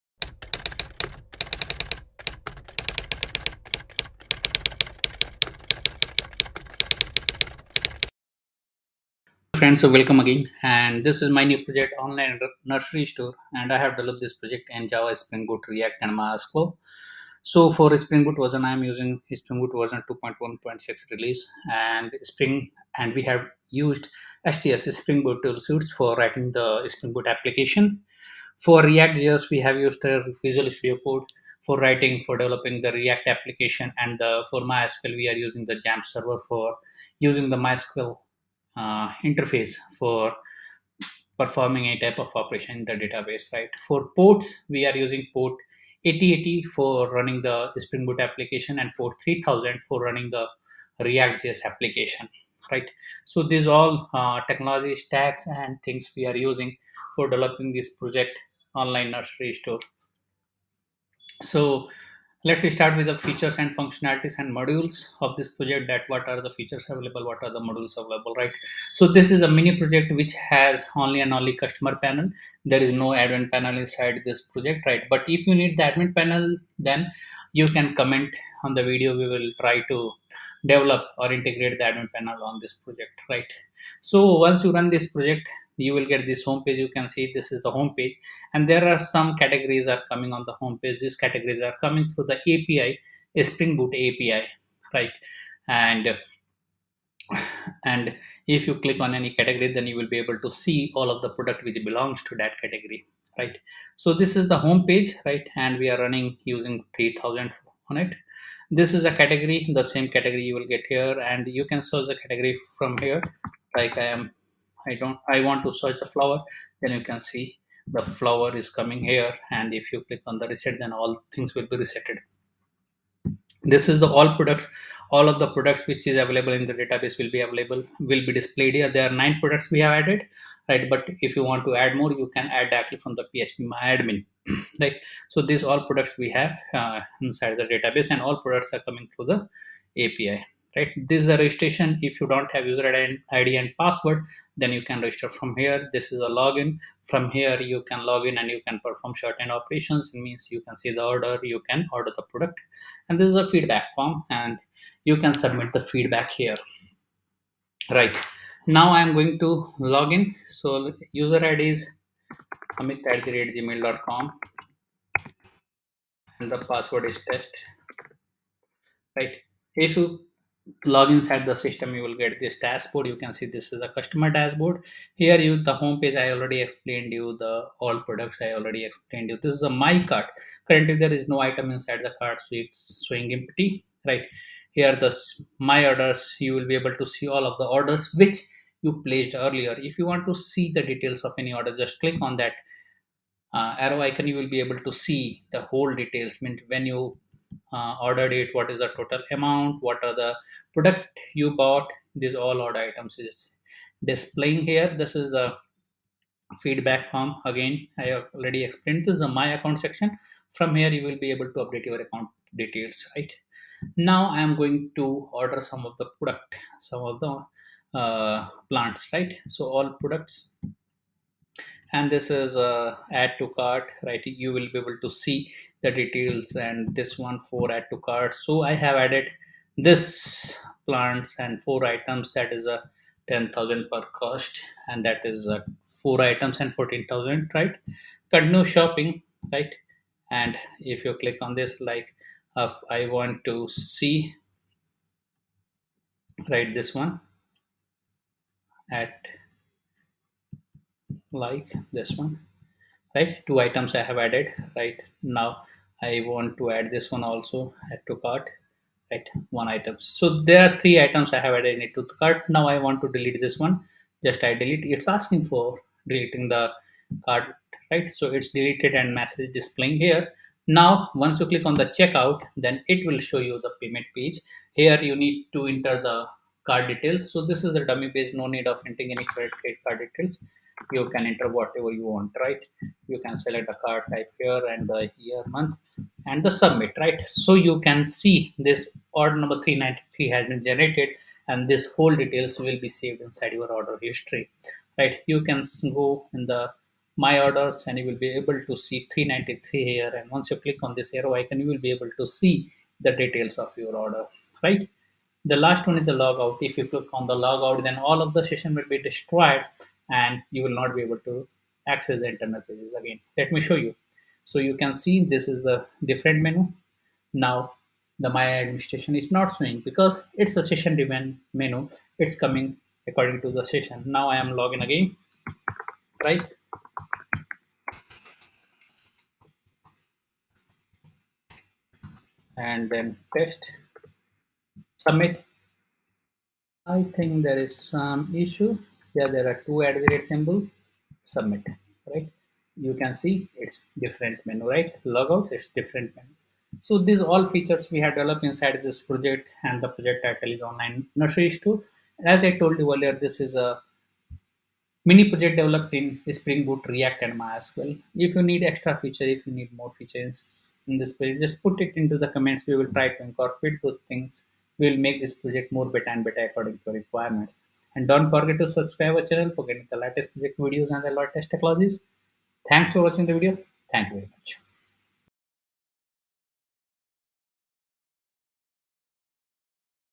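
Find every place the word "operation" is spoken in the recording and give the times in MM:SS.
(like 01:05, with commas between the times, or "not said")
00:42, 02:29.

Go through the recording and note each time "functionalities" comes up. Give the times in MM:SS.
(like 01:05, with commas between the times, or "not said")
01:03.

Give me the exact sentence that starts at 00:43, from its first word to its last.
For ports, we are using port 8080 for running the Spring Boot application and port 3000 for running the React.js application, right?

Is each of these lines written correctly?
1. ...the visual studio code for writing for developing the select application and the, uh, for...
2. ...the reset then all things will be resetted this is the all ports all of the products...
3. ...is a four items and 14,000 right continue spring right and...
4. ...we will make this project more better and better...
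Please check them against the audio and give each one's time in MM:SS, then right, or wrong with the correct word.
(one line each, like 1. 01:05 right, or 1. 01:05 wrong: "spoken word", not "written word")
1. 00:30 wrong: "react", not "select"
2. 02:00 wrong: "products", not "ports"
3. 03:55 wrong: "shopping", not "spring"
4. 06:04 right.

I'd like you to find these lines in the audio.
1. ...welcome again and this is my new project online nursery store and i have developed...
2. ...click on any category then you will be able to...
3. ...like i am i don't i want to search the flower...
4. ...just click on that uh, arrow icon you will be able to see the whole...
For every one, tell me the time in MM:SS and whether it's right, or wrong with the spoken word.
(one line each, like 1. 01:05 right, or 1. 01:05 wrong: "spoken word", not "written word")
1. 00:09 right
2. 01:38 right
3. 01:53 right
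4. 03:11 right.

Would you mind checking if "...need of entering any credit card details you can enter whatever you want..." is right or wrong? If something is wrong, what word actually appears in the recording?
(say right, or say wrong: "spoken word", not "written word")
right.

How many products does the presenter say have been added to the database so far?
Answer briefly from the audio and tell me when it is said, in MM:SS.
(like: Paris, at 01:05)
9, at 02:09.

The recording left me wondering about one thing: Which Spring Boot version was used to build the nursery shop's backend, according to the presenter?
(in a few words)
2.1.6.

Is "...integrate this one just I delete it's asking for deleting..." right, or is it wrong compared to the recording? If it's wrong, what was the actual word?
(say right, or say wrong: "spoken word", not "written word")
wrong: "delete", not "integrate".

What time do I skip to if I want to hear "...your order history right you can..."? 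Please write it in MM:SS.
04:53.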